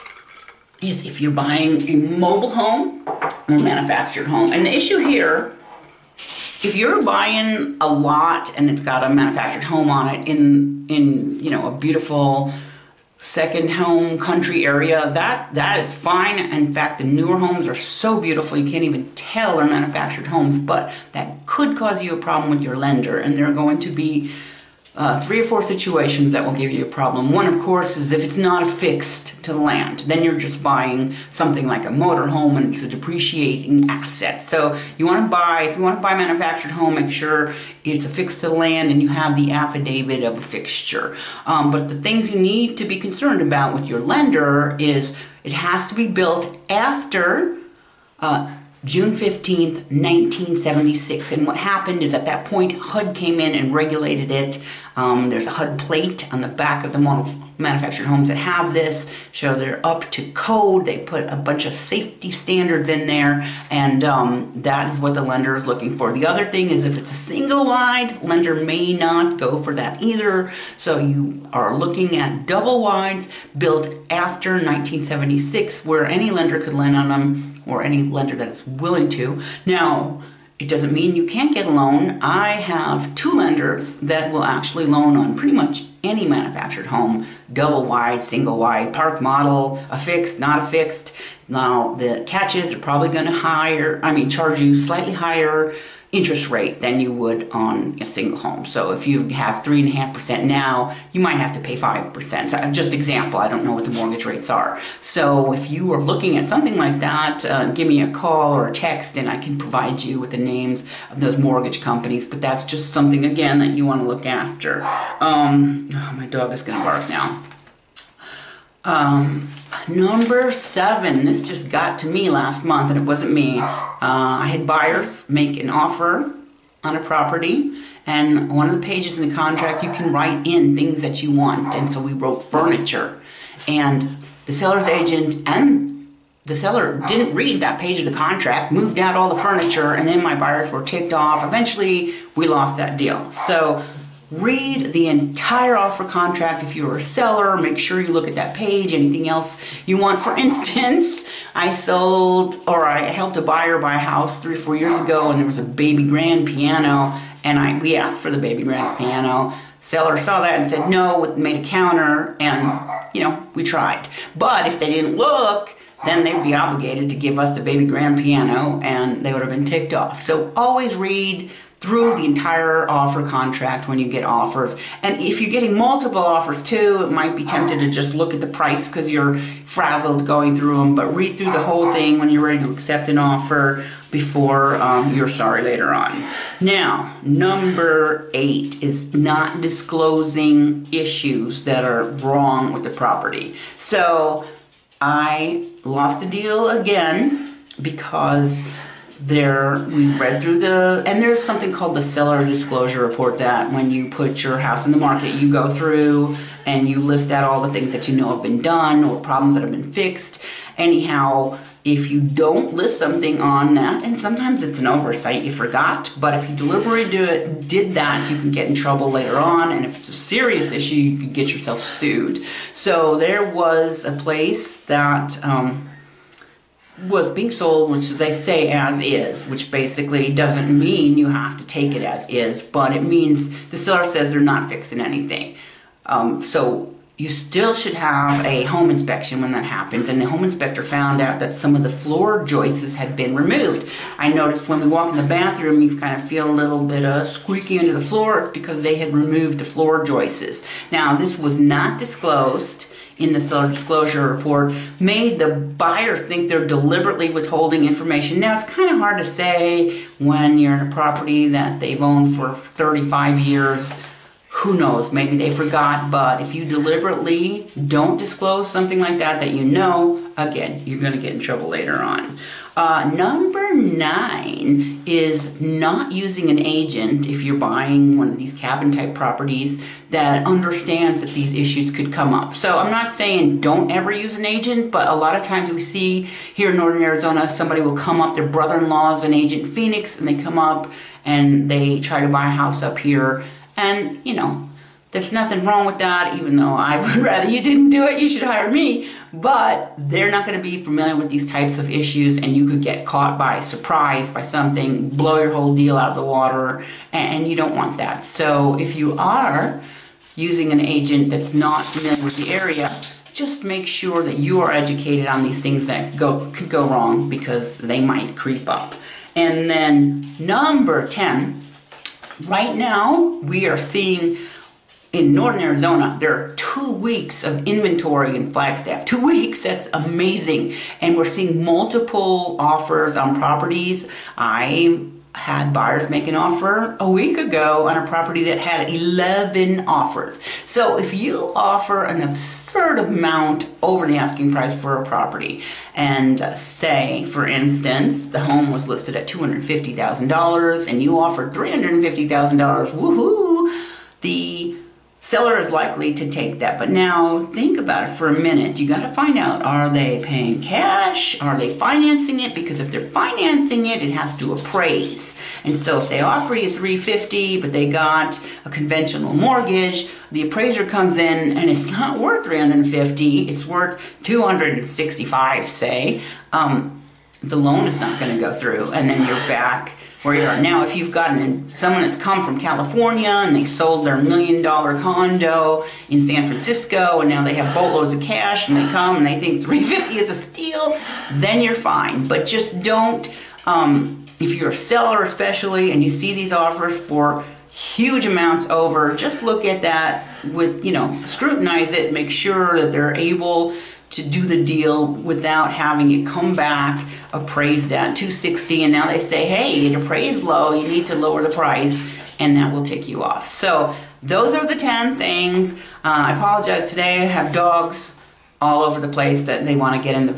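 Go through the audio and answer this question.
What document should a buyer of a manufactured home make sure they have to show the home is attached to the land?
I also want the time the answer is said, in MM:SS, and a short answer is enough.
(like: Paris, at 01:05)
affidavit of affixture, at 00:39.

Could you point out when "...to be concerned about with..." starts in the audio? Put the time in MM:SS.
00:42.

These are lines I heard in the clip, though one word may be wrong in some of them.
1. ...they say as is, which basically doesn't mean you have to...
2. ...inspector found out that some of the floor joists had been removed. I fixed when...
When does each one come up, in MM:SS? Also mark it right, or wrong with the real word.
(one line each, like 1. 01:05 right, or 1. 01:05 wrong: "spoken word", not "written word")
1. 03:48 right
2. 04:00 wrong: "noticed", not "fixed".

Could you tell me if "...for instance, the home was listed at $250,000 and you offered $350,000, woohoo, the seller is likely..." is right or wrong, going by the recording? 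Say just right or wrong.
right.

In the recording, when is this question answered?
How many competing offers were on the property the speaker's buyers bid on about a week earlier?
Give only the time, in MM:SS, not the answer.
05:38.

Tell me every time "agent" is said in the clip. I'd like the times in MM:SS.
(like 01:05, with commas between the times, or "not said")
02:14, 04:36, 04:44, 04:49, 05:10.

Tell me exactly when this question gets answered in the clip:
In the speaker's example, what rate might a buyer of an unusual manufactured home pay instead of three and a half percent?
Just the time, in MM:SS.
01:41.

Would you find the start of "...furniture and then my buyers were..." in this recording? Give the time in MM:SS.
02:19.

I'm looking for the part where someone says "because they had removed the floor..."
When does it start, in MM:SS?
04:08.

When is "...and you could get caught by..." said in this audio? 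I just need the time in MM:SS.
05:02.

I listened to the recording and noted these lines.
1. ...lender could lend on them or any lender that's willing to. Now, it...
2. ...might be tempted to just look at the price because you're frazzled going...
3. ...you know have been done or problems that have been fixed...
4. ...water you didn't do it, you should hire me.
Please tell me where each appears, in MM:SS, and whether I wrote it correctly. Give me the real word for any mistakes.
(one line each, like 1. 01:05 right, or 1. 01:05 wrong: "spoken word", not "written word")
1. 01:16 right
2. 02:57 right
3. 03:28 right
4. 04:57 wrong: "rather", not "water".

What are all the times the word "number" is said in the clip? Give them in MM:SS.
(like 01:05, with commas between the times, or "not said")
01:59, 03:07, 04:33, 05:20.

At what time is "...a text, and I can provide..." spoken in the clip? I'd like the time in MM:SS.
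01:48.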